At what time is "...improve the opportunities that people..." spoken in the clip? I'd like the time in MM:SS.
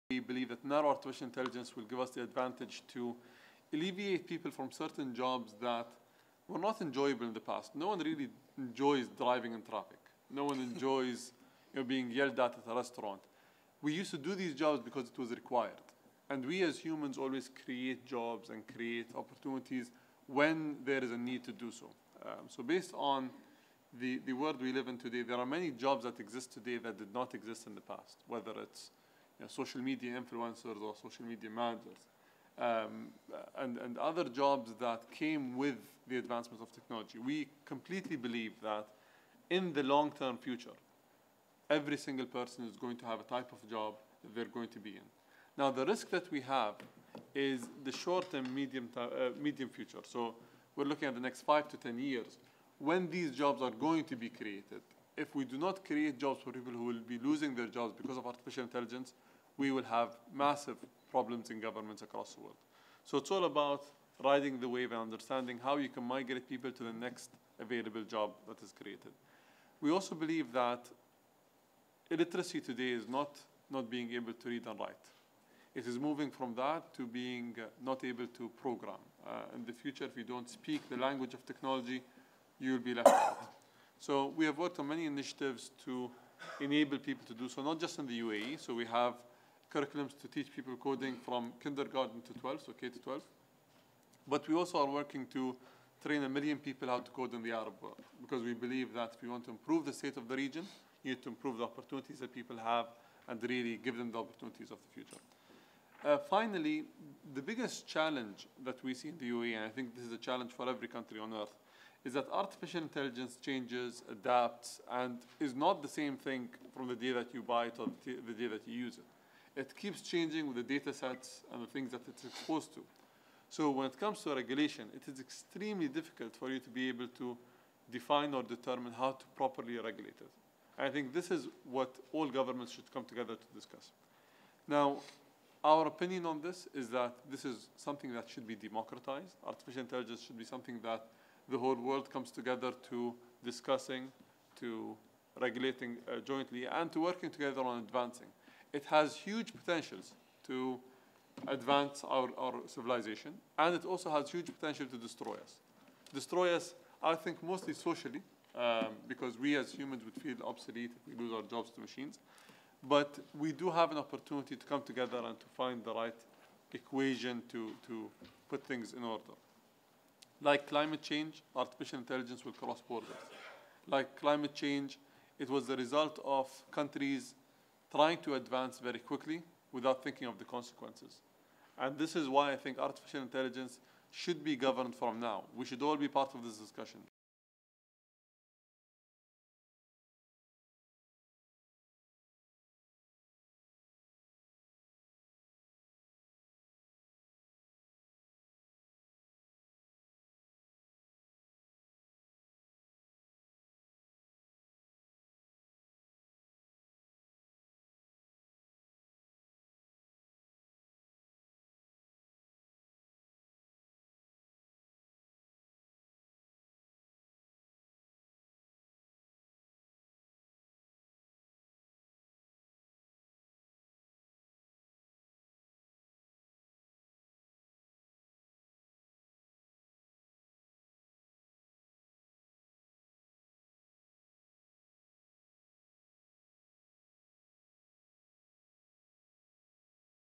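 01:41.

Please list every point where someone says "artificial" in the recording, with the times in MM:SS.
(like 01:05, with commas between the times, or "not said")
00:00, 00:58, 01:52, 02:19, 02:51, 03:02.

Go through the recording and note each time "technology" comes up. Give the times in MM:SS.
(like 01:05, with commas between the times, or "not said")
00:36, 01:21.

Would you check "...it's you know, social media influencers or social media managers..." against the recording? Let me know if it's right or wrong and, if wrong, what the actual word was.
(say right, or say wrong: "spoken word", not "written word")
right.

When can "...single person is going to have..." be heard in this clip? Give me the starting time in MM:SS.
00:41.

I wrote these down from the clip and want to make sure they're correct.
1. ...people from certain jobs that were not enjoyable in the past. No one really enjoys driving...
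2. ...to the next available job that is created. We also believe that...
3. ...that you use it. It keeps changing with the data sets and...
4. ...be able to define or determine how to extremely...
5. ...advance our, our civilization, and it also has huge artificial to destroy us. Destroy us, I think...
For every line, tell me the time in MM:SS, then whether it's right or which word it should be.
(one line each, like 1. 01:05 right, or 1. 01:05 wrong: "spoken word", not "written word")
1. 00:04 right
2. 01:06 right
3. 01:58 right
4. 02:06 wrong: "properly", not "extremely"
5. 02:31 wrong: "potential", not "artificial".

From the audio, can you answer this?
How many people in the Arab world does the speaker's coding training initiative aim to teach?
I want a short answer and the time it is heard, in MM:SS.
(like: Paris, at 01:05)
1 million, at 01:36.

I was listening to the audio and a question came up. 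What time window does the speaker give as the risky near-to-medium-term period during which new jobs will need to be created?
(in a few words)
5 to 10 years.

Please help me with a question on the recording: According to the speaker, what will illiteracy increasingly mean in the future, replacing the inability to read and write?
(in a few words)
not able to program.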